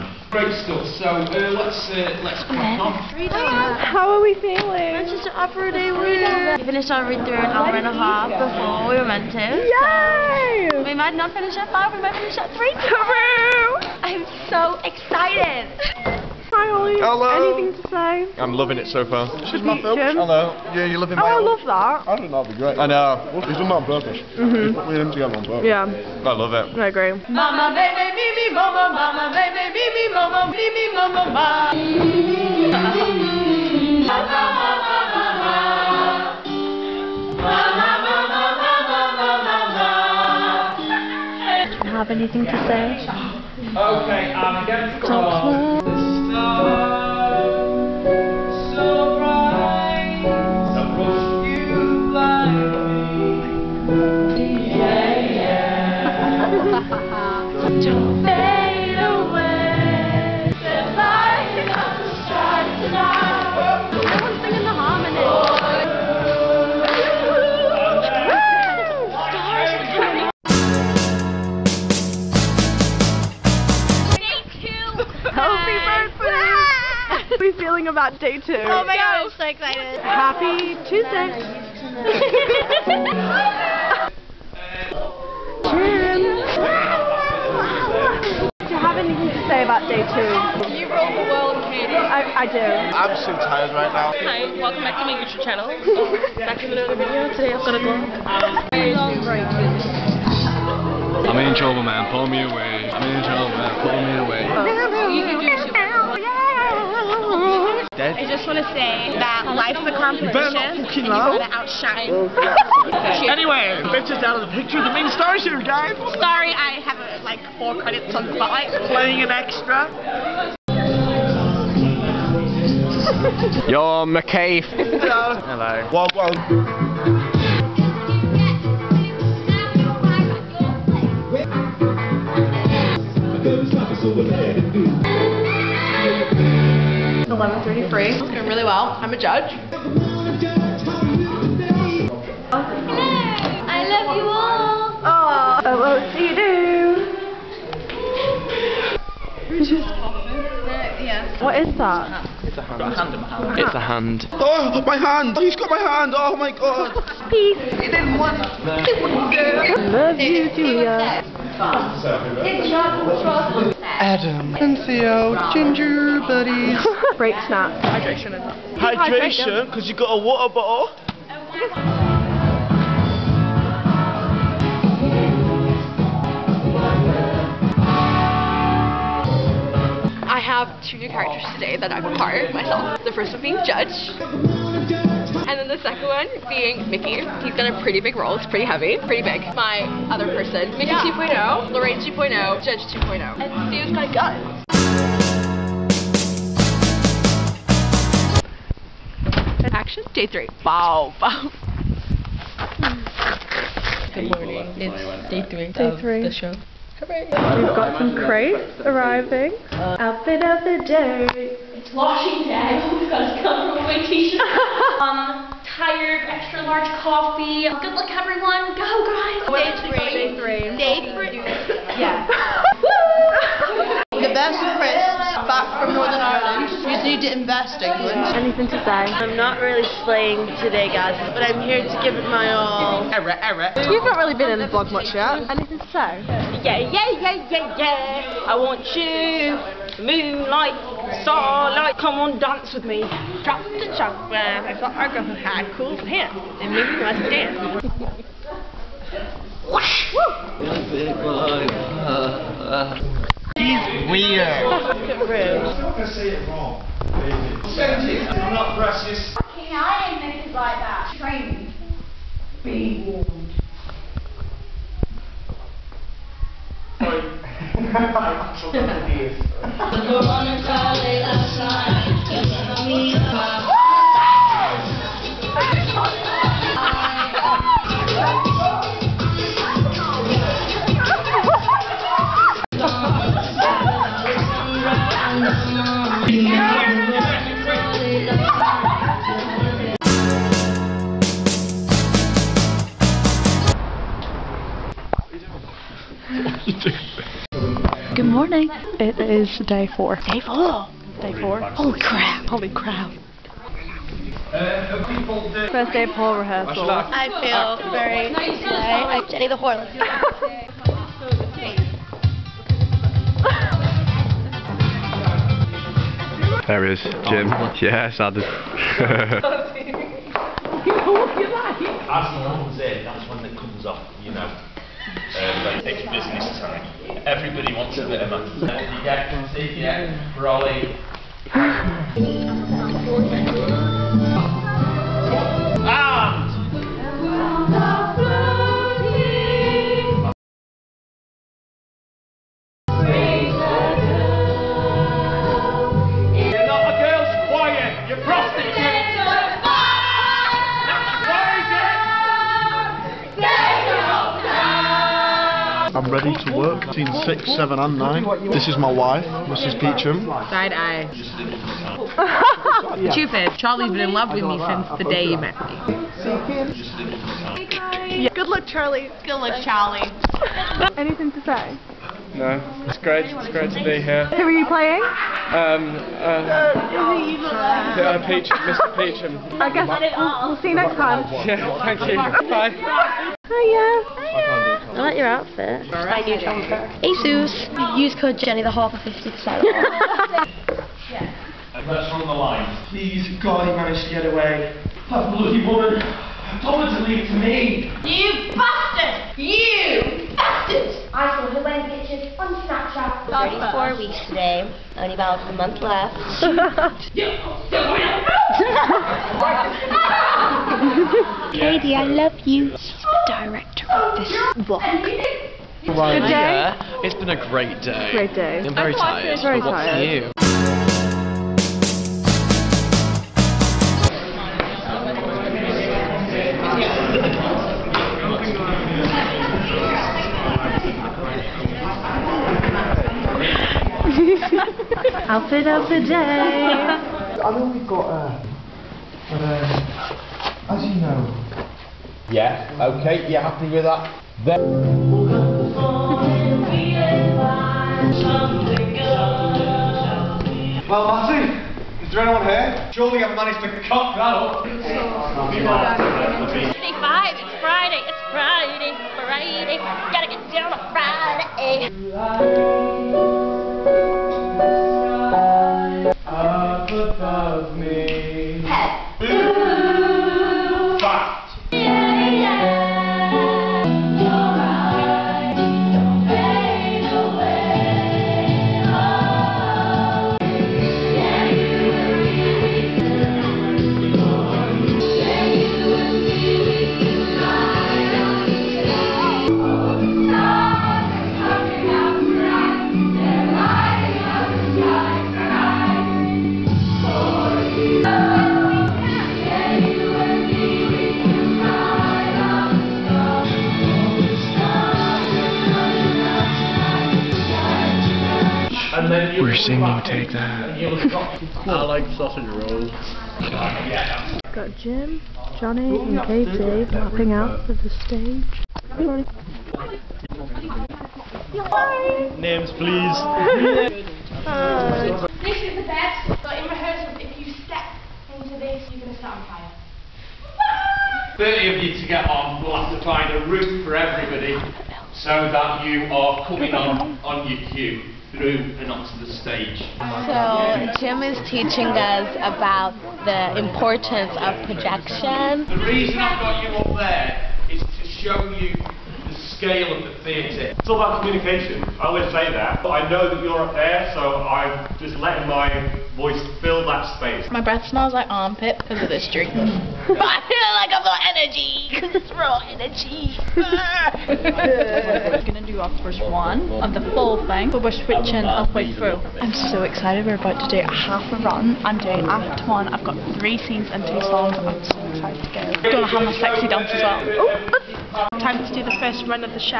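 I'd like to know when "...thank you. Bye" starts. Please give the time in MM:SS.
06:21.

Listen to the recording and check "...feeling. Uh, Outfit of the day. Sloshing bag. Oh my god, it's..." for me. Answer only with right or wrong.
wrong.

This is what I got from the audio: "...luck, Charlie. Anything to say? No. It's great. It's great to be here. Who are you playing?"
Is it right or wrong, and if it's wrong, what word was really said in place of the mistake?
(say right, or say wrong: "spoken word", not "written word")
right.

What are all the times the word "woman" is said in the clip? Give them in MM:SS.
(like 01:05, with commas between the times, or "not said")
06:35.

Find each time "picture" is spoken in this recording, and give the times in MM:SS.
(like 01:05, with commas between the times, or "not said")
01:54, 06:42.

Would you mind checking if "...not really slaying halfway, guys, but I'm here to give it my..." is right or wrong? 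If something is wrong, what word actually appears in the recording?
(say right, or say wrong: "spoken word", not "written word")
wrong: "today", not "halfway".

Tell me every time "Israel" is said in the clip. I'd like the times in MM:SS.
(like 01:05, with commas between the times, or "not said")
not said.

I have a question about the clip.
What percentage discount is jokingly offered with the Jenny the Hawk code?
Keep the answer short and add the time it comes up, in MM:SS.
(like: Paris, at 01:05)
50%, at 06:28.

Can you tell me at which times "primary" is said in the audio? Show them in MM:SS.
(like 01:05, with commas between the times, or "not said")
not said.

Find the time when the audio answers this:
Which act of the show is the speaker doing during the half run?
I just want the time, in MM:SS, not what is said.
09:32.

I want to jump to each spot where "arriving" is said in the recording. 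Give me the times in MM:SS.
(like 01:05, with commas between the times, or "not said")
03:28.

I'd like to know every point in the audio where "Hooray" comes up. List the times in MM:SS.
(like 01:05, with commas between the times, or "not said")
03:26.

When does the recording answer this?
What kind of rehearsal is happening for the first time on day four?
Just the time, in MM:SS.
05:06.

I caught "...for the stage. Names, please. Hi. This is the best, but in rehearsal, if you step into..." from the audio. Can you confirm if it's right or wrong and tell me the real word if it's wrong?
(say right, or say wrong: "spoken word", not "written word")
right.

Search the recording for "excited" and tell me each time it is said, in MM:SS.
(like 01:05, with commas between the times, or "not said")
00:14, 01:19, 09:29, 09:35.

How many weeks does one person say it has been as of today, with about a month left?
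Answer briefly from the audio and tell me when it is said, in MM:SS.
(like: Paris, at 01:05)
34, at 06:43.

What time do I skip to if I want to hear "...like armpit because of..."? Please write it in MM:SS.
09:18.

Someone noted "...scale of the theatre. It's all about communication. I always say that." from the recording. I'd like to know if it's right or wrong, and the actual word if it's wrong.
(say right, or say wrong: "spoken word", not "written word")
right.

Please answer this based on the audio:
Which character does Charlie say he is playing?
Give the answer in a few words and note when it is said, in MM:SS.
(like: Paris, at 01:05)
Mr. Peachum, at 06:18.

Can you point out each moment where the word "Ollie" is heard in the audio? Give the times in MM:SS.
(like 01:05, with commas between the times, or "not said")
00:16.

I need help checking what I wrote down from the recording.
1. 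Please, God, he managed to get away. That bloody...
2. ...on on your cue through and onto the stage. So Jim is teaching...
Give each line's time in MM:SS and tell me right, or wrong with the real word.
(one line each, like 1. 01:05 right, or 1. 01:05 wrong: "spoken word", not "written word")
1. 06:32 right
2. 08:56 right.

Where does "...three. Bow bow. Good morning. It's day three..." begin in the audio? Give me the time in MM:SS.
03:20.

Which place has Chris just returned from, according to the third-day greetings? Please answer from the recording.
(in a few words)
Northern Ireland.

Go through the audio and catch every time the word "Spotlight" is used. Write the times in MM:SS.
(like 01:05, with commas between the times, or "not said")
01:58.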